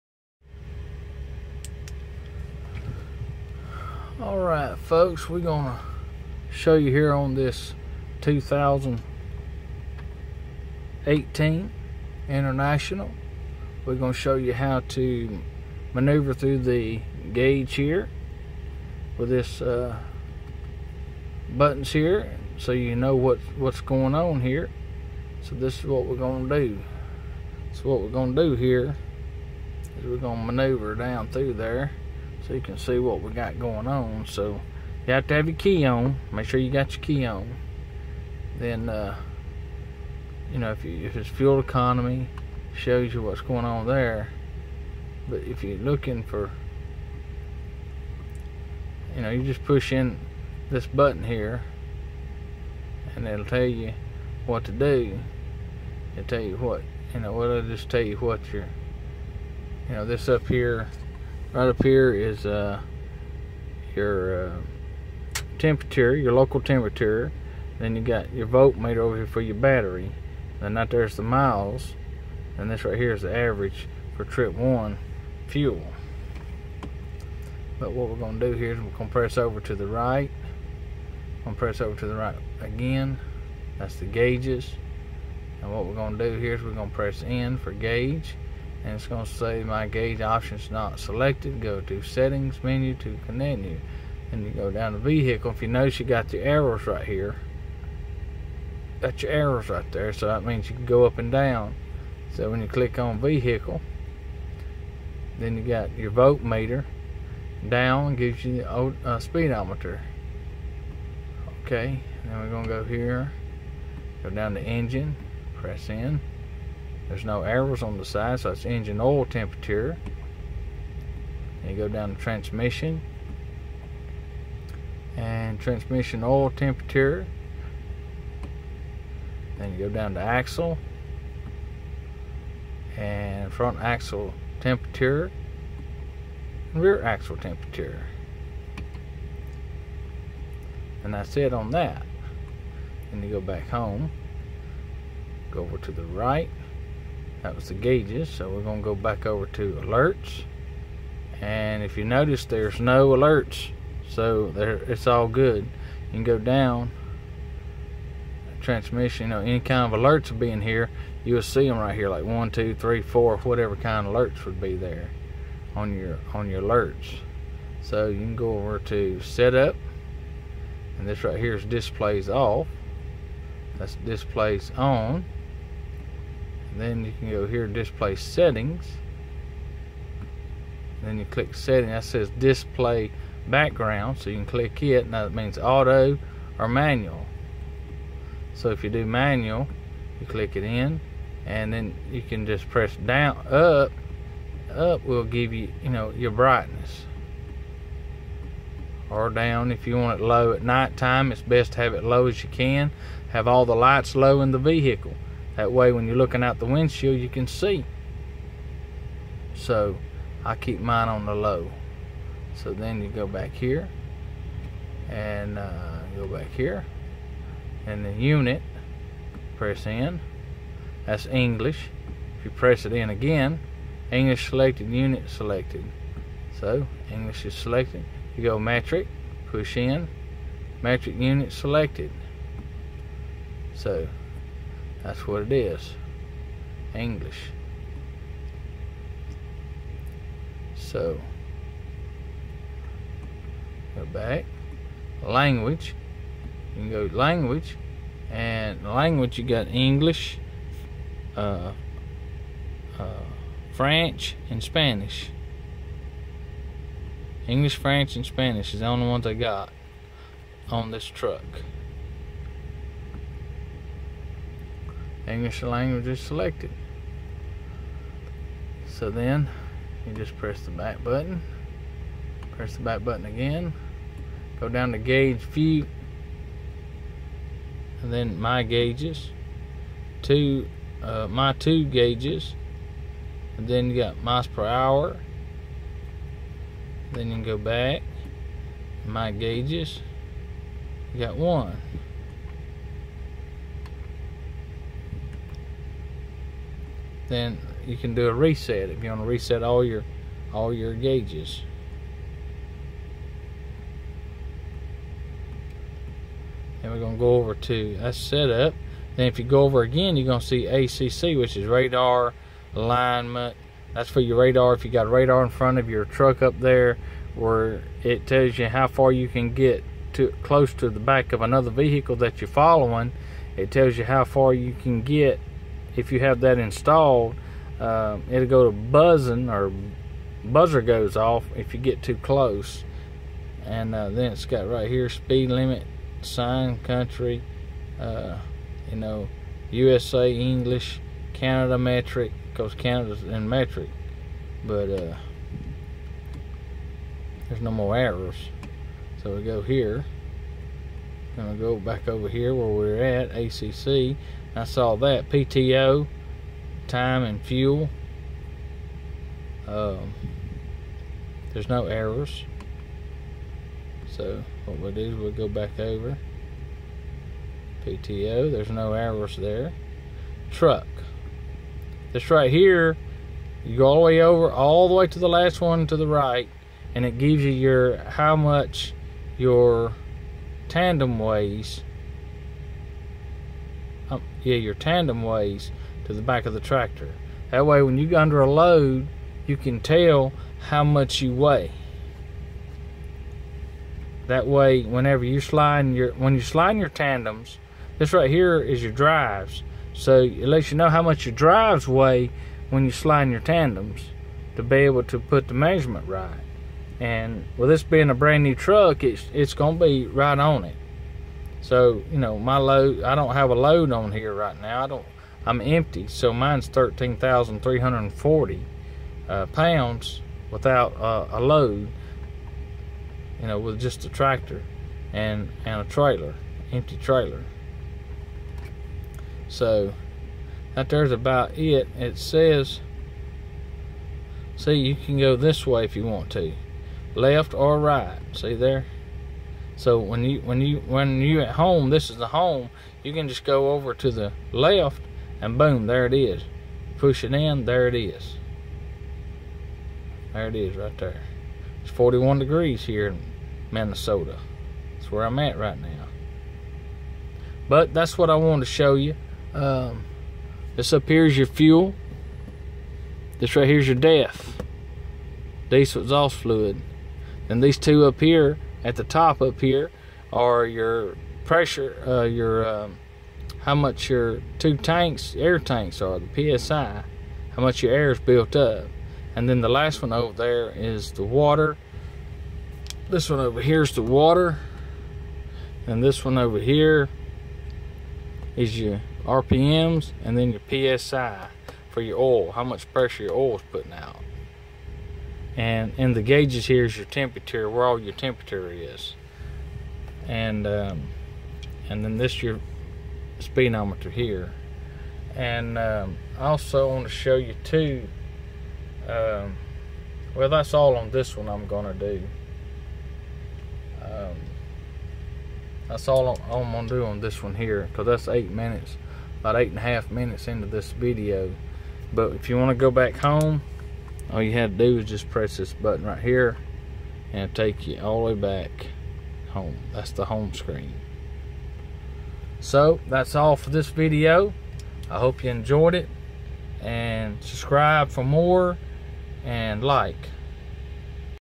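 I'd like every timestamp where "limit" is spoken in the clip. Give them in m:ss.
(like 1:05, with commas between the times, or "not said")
5:35.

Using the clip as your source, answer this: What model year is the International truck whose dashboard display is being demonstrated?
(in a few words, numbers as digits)
2018.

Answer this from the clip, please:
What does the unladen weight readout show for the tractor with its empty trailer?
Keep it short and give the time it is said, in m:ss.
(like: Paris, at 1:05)
13,340 pounds, at 6:56.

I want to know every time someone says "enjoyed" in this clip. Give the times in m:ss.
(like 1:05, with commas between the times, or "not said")
8:55.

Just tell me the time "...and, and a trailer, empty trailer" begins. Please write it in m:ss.
7:05.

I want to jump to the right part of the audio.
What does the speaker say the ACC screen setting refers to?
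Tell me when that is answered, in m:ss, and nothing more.
5:11.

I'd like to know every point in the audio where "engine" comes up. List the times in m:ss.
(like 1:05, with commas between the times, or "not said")
1:54, 1:58.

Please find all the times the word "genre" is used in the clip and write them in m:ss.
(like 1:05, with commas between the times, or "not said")
not said.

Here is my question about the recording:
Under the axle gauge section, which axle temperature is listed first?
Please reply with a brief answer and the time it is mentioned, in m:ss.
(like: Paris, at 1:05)
front axle temperature, at 2:13.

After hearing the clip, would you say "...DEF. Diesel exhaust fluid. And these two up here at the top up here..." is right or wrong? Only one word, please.
right.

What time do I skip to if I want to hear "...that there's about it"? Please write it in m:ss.
7:10.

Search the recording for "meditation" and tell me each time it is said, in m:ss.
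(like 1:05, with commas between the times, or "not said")
not said.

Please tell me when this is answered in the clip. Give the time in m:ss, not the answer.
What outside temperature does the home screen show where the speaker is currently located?
7:31.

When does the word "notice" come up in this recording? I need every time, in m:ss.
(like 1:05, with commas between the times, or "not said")
1:35, 2:32.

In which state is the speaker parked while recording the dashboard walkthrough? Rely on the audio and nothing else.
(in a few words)
Minnesota.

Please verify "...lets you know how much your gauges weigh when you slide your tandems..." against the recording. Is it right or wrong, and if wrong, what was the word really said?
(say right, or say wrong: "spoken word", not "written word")
wrong: "drives", not "gauges".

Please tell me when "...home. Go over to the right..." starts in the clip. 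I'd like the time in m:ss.
2:23.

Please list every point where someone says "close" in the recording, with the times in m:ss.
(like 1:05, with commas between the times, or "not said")
5:20, 5:32.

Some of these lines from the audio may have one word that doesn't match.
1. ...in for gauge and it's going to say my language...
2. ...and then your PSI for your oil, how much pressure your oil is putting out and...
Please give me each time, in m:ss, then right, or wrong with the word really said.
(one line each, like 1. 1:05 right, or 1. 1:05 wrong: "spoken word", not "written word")
1. 1:27 wrong: "gauge", not "language"
2. 8:10 right.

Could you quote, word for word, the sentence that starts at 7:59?
And then the last one over there is the water.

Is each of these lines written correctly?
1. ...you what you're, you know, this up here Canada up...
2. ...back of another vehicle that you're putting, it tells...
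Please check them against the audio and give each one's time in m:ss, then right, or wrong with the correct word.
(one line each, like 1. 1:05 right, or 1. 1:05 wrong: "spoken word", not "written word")
1. 0:58 wrong: "Right", not "Canada"
2. 5:20 wrong: "following", not "putting".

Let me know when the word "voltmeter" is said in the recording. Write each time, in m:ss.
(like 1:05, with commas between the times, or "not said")
1:08, 1:46.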